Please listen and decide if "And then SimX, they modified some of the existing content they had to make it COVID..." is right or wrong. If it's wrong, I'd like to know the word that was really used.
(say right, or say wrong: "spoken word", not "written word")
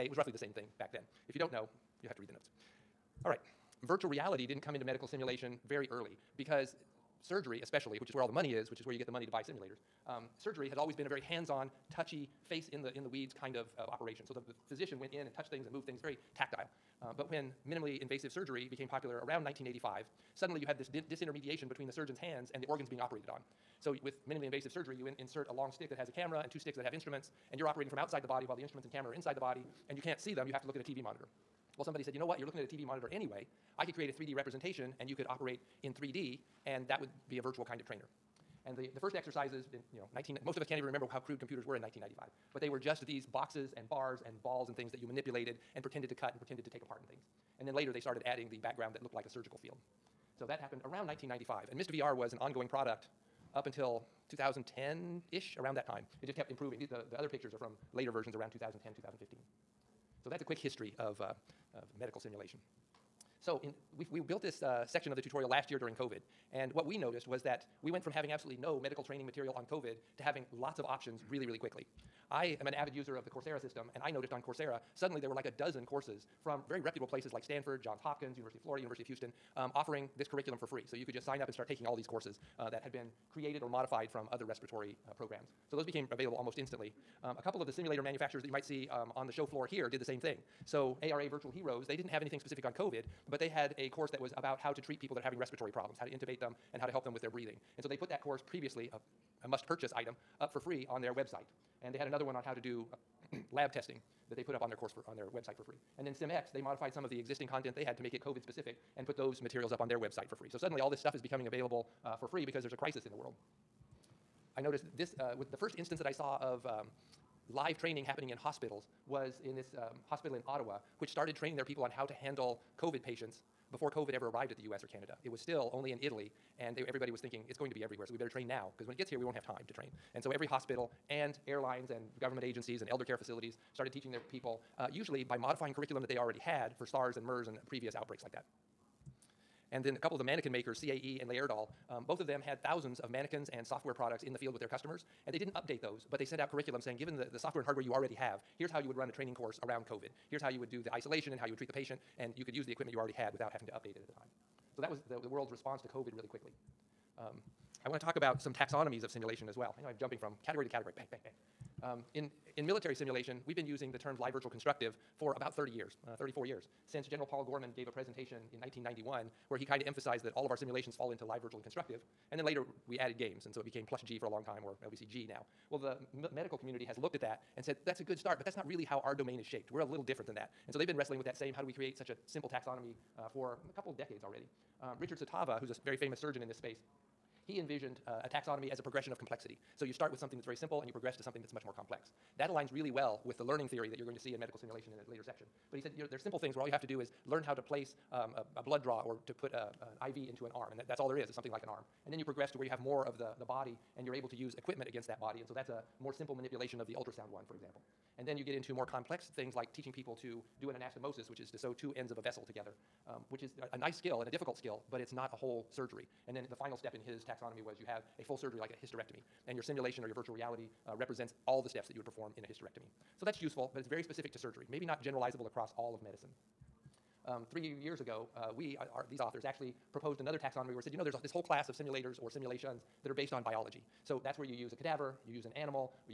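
right.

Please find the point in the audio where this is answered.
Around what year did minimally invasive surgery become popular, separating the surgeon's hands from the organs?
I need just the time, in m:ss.
0:19.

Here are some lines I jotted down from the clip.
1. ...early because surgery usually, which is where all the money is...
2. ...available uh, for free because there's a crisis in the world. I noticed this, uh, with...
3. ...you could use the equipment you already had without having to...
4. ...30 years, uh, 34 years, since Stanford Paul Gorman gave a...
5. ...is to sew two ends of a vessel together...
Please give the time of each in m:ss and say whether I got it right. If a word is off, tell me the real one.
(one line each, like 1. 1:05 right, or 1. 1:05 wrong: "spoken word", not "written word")
1. 0:05 wrong: "especially", not "usually"
2. 1:51 right
3. 2:32 right
4. 2:45 wrong: "General", not "Stanford"
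5. 3:31 right.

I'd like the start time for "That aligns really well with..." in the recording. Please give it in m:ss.
3:12.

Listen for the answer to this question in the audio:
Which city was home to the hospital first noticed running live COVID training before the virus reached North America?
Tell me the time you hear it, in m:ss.
2:00.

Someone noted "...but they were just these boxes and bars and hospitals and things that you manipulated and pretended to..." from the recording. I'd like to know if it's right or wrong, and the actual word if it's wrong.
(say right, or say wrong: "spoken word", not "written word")
wrong: "balls", not "hospitals".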